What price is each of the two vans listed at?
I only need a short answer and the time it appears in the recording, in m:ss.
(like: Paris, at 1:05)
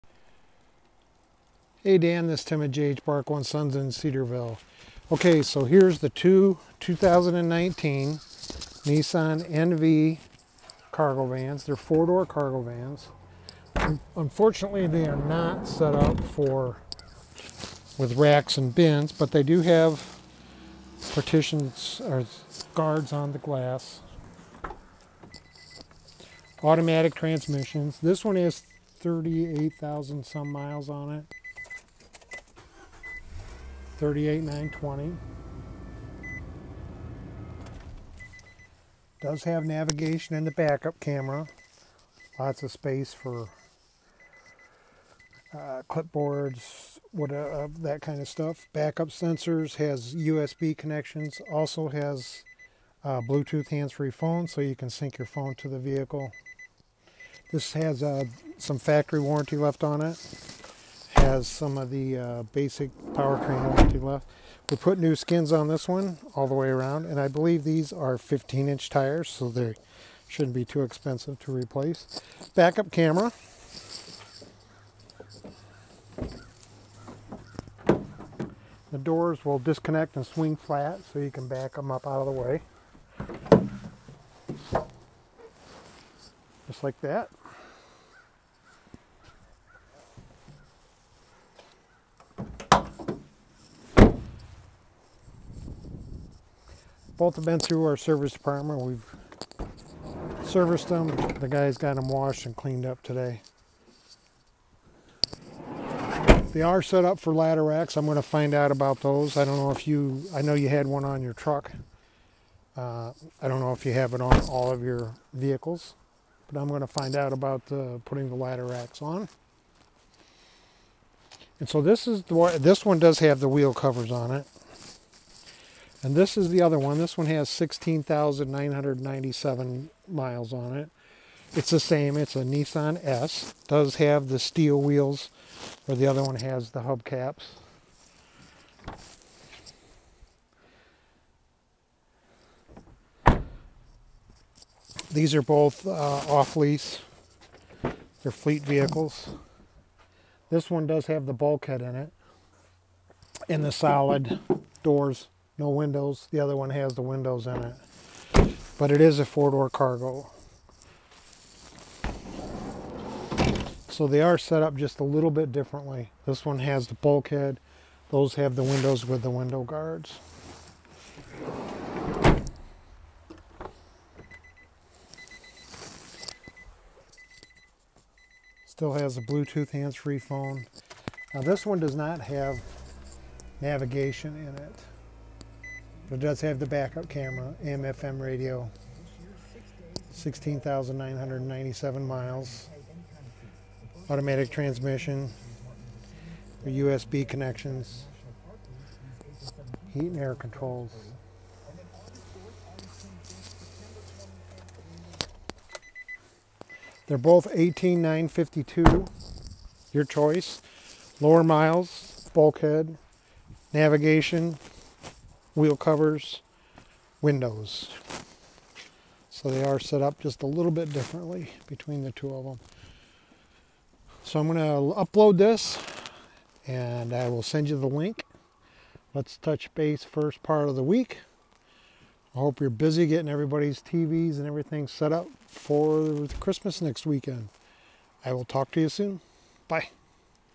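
18,952, at 3:27.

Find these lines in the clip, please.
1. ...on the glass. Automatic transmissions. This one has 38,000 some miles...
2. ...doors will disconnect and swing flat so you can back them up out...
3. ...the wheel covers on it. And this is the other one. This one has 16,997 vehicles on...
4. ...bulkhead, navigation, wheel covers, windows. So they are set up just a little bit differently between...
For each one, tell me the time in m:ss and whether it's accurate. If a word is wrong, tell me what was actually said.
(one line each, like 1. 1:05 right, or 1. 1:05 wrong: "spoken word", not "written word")
1. 0:23 right
2. 1:18 right
3. 2:03 wrong: "miles", not "vehicles"
4. 3:32 right.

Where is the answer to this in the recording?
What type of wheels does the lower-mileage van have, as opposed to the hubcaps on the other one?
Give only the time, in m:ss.
2:14.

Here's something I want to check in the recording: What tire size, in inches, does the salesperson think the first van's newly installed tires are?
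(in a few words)
15.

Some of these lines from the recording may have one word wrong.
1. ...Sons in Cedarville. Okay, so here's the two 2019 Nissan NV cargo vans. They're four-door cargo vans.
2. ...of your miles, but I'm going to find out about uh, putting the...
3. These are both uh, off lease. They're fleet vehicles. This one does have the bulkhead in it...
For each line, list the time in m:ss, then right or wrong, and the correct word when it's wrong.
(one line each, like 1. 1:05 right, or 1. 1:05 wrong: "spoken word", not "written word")
1. 0:03 right
2. 1:54 wrong: "vehicles", not "miles"
3. 2:25 right.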